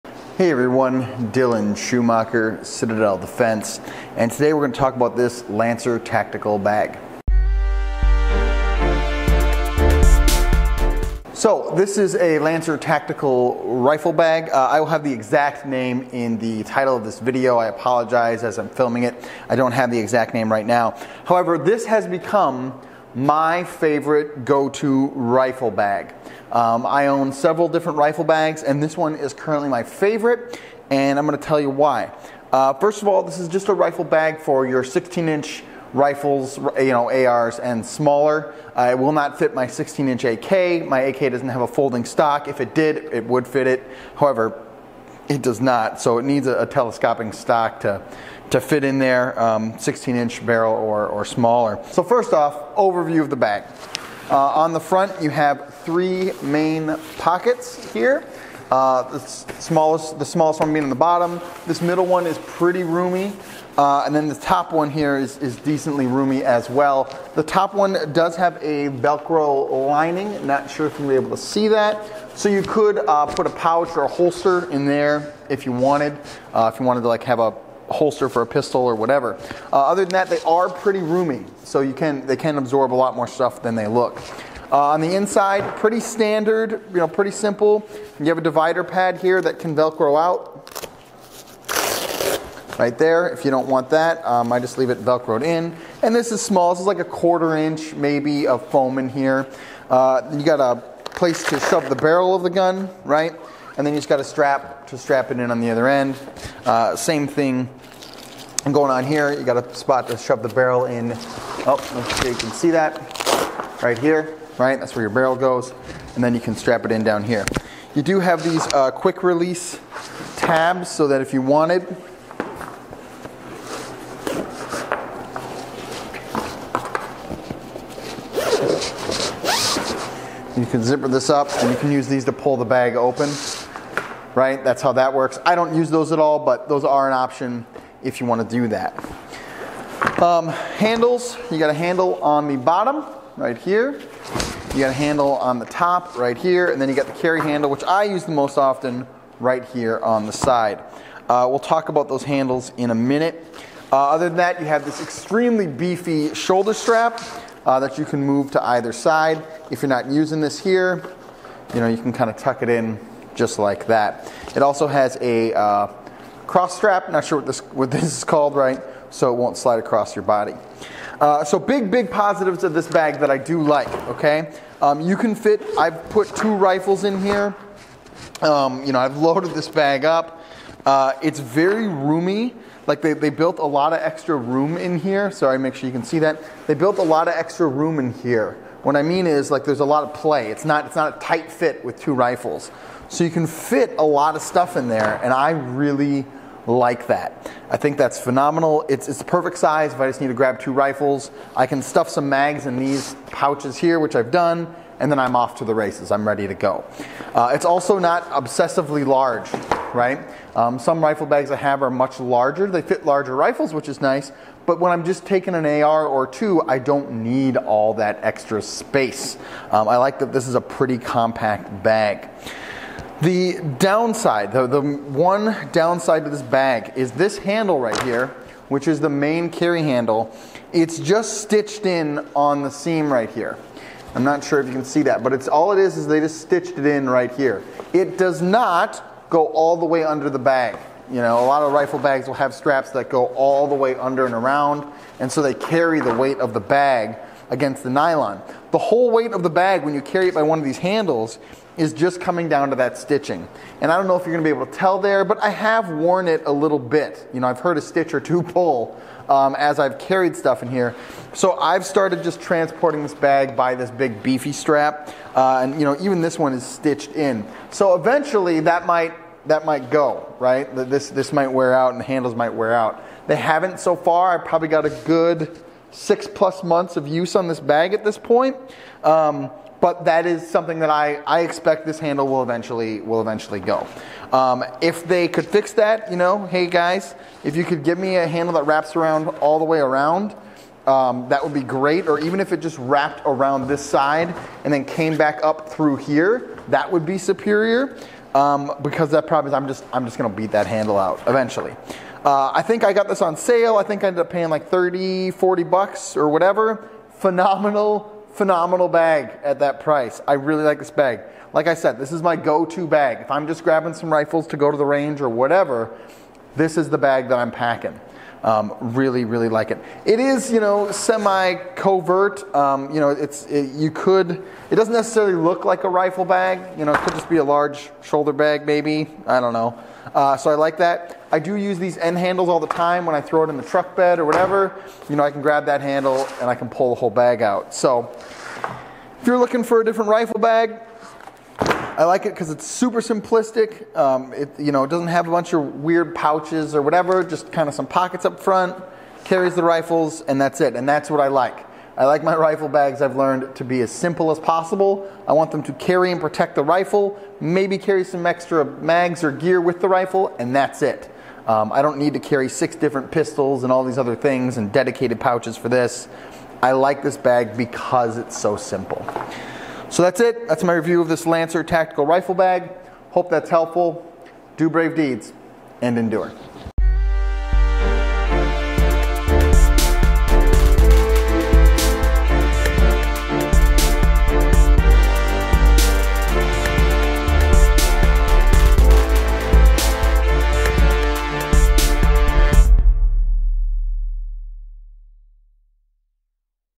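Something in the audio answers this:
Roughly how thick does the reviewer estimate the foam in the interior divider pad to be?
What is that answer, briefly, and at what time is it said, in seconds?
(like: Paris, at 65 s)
a quarter inch, at 96 s.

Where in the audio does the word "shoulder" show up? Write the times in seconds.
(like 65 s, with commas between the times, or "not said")
156 s, 328 s.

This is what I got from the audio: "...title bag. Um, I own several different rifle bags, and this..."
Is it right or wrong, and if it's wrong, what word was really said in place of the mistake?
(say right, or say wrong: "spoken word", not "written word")
wrong: "rifle", not "title".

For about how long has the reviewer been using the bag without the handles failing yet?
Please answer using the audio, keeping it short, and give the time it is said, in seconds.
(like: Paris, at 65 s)
6+ months, at 275 s.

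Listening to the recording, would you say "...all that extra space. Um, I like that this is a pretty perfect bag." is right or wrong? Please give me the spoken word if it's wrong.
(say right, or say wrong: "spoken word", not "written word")
wrong: "compact", not "perfect".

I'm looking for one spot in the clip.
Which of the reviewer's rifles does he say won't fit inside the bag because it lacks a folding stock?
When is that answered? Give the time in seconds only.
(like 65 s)
39 s.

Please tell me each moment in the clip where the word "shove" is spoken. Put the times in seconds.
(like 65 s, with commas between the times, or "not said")
101 s, 110 s.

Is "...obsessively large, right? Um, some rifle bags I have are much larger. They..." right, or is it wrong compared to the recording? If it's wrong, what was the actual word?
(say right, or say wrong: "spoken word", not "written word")
right.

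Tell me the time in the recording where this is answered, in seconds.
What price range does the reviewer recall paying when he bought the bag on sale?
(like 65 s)
304 s.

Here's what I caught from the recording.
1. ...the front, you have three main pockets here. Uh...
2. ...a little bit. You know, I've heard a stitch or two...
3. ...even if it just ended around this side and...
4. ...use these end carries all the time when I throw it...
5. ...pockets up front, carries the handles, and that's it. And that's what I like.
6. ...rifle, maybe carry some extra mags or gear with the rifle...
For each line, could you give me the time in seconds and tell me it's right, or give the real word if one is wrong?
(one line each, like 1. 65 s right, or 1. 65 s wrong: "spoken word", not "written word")
1. 54 s right
2. 256 s right
3. 292 s wrong: "wrapped", not "ended"
4. 331 s wrong: "handles", not "carries"
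5. 347 s wrong: "rifles", not "handles"
6. 356 s right.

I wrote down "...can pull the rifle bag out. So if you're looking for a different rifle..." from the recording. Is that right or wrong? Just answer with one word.
wrong.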